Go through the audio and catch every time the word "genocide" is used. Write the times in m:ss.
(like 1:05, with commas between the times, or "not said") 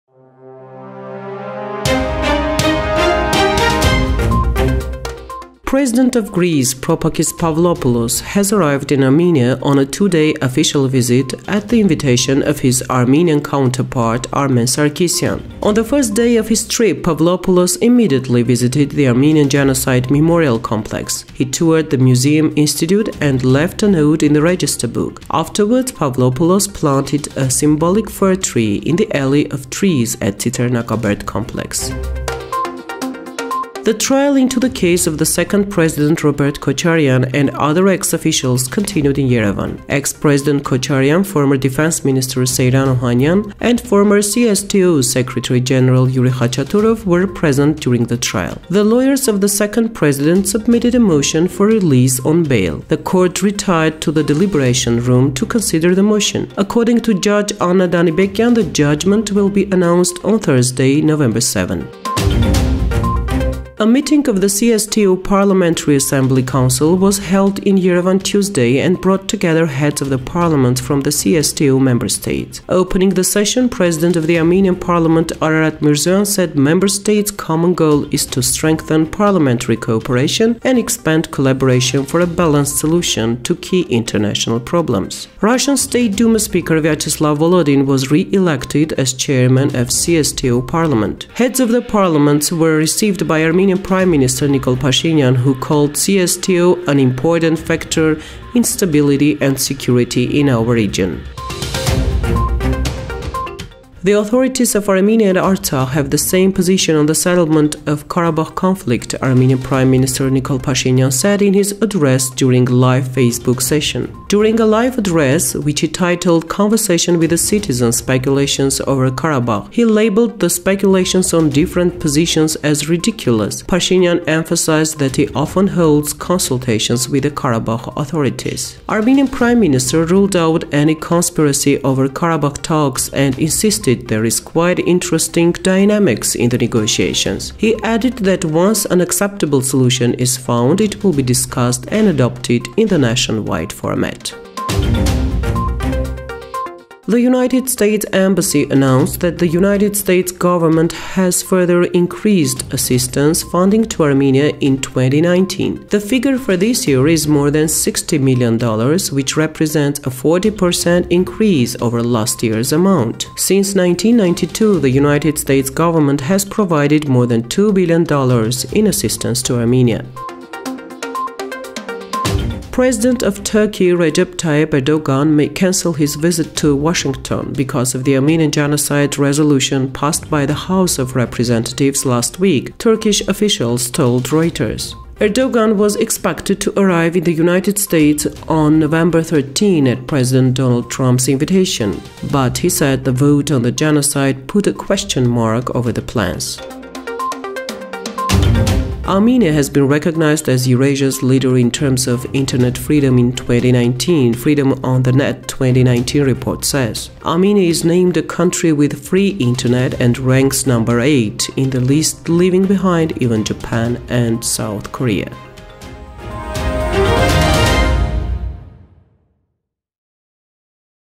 0:19, 2:58, 3:13.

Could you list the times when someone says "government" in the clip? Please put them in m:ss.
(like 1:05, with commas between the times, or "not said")
2:30, 2:45.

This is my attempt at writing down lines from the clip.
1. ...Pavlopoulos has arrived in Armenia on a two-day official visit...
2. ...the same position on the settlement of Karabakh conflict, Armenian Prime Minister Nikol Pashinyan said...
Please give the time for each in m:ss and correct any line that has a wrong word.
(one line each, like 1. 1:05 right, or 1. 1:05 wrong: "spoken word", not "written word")
1. 0:07 right
2. 1:46 right.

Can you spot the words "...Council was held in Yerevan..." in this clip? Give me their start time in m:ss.
1:06.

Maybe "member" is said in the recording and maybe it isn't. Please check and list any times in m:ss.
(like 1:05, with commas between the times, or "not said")
1:11, 1:16.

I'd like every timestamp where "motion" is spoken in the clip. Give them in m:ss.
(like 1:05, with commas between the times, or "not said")
0:50, 0:56.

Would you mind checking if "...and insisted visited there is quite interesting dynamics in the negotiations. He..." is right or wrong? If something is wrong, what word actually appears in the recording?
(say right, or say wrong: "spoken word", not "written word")
wrong: "noted", not "visited".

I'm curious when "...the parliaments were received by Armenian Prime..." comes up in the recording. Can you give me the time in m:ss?
1:31.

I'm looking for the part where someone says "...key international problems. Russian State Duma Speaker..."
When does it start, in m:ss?
1:23.